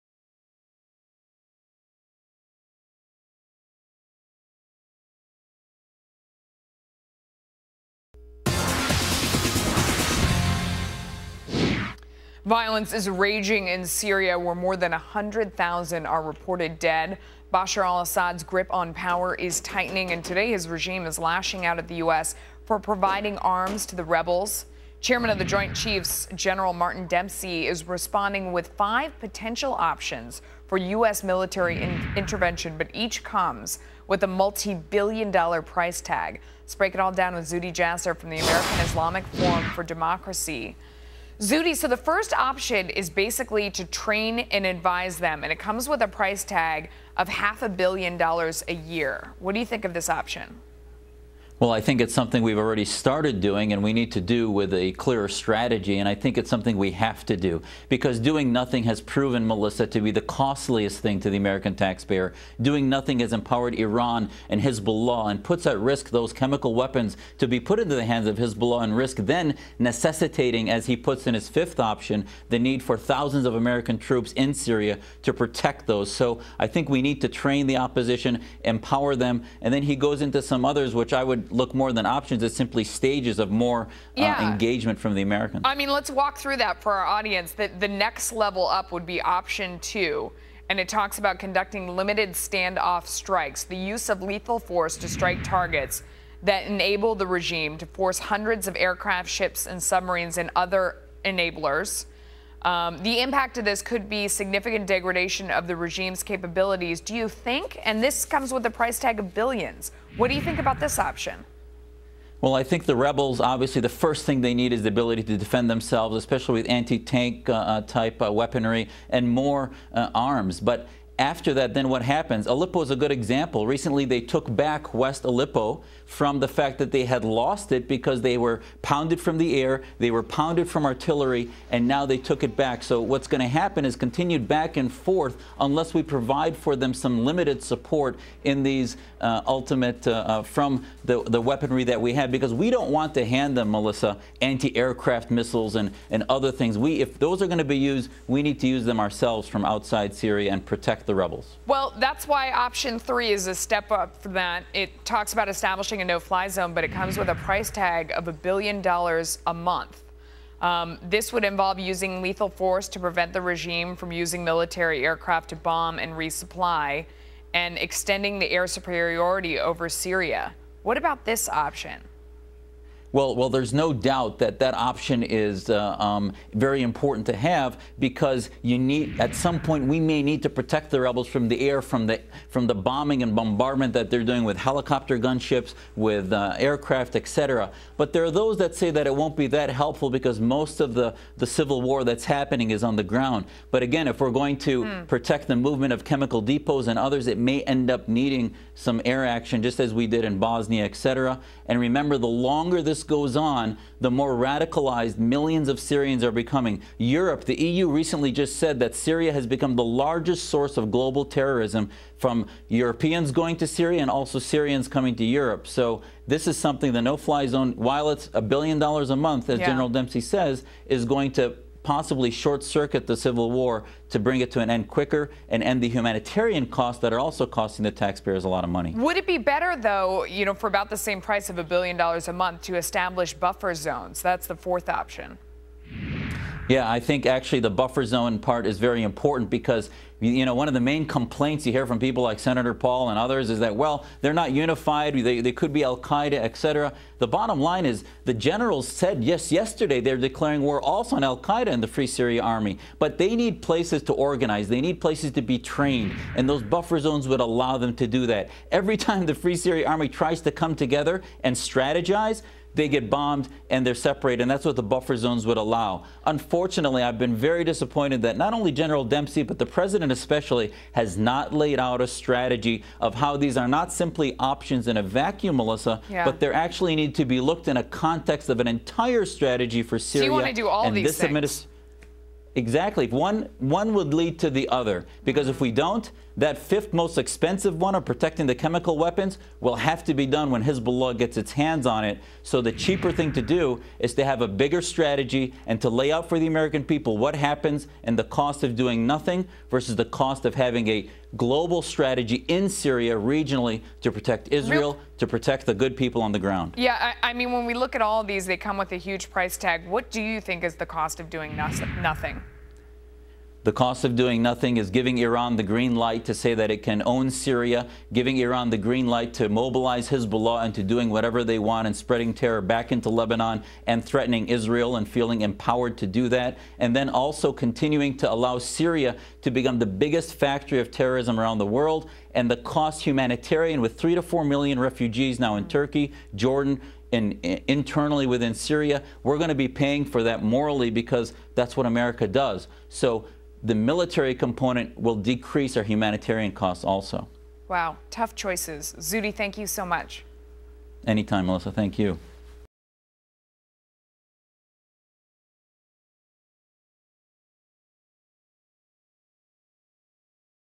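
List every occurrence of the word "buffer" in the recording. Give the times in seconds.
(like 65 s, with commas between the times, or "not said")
233 s, 237 s, 256 s, 264 s.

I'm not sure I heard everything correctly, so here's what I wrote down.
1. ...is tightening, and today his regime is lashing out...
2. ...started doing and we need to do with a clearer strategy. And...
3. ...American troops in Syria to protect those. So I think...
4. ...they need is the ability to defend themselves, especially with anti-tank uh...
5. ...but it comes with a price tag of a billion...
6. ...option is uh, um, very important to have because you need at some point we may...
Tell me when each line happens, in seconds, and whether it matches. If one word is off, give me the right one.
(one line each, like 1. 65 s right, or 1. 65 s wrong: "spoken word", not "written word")
1. 19 s right
2. 52 s right
3. 73 s right
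4. 114 s right
5. 156 s right
6. 174 s right.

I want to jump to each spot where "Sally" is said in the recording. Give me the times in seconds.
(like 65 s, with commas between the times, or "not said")
not said.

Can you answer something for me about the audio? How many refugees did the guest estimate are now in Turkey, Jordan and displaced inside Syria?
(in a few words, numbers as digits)
3 to 4 million.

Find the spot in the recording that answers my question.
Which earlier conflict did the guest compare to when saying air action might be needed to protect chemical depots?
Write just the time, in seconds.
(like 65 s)
200 s.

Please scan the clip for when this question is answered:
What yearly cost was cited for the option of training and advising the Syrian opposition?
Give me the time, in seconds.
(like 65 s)
47 s.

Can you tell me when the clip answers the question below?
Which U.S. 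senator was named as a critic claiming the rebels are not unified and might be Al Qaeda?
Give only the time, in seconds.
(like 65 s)
242 s.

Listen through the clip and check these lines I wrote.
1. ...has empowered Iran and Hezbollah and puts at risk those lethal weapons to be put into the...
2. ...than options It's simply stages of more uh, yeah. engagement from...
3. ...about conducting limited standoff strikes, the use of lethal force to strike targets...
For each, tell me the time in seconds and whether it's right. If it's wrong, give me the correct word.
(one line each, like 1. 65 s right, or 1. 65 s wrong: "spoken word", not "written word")
1. 63 s wrong: "chemical", not "lethal"
2. 81 s right
3. 91 s right.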